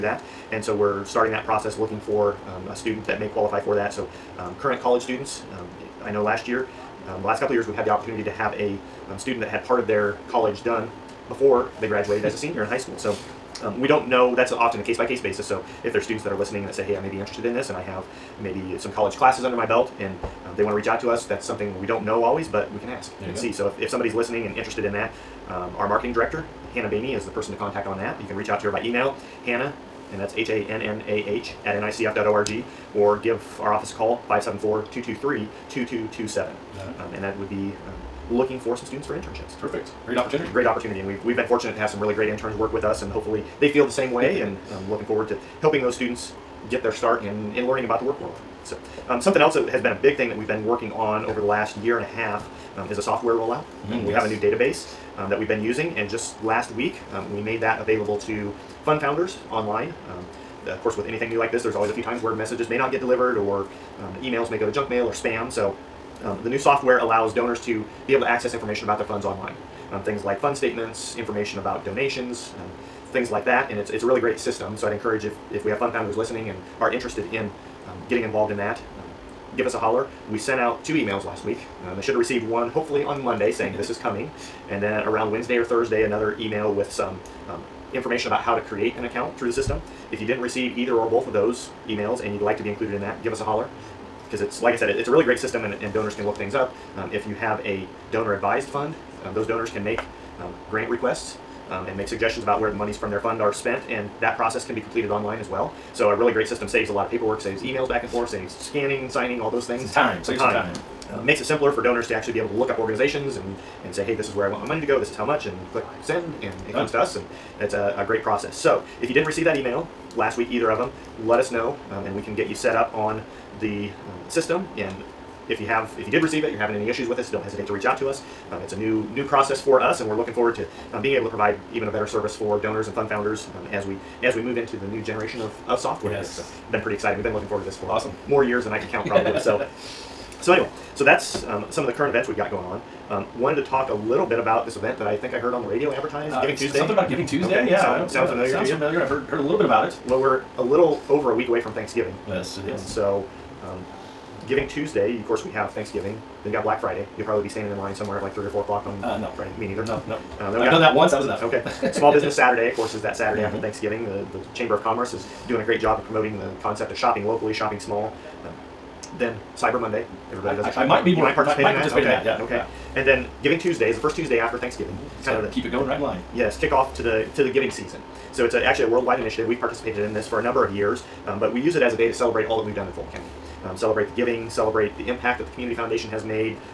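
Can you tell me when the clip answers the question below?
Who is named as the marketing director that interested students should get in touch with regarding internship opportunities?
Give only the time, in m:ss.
0:26.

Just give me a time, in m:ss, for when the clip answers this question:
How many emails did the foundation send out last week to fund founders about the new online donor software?
1:20.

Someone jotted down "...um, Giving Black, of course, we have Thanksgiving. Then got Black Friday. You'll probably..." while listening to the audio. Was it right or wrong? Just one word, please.
wrong.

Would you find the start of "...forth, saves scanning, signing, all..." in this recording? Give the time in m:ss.
1:48.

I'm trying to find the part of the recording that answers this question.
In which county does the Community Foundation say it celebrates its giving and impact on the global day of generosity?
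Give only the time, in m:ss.
3:02.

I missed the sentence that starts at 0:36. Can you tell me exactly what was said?
Um, and that would be looking for some students for internships.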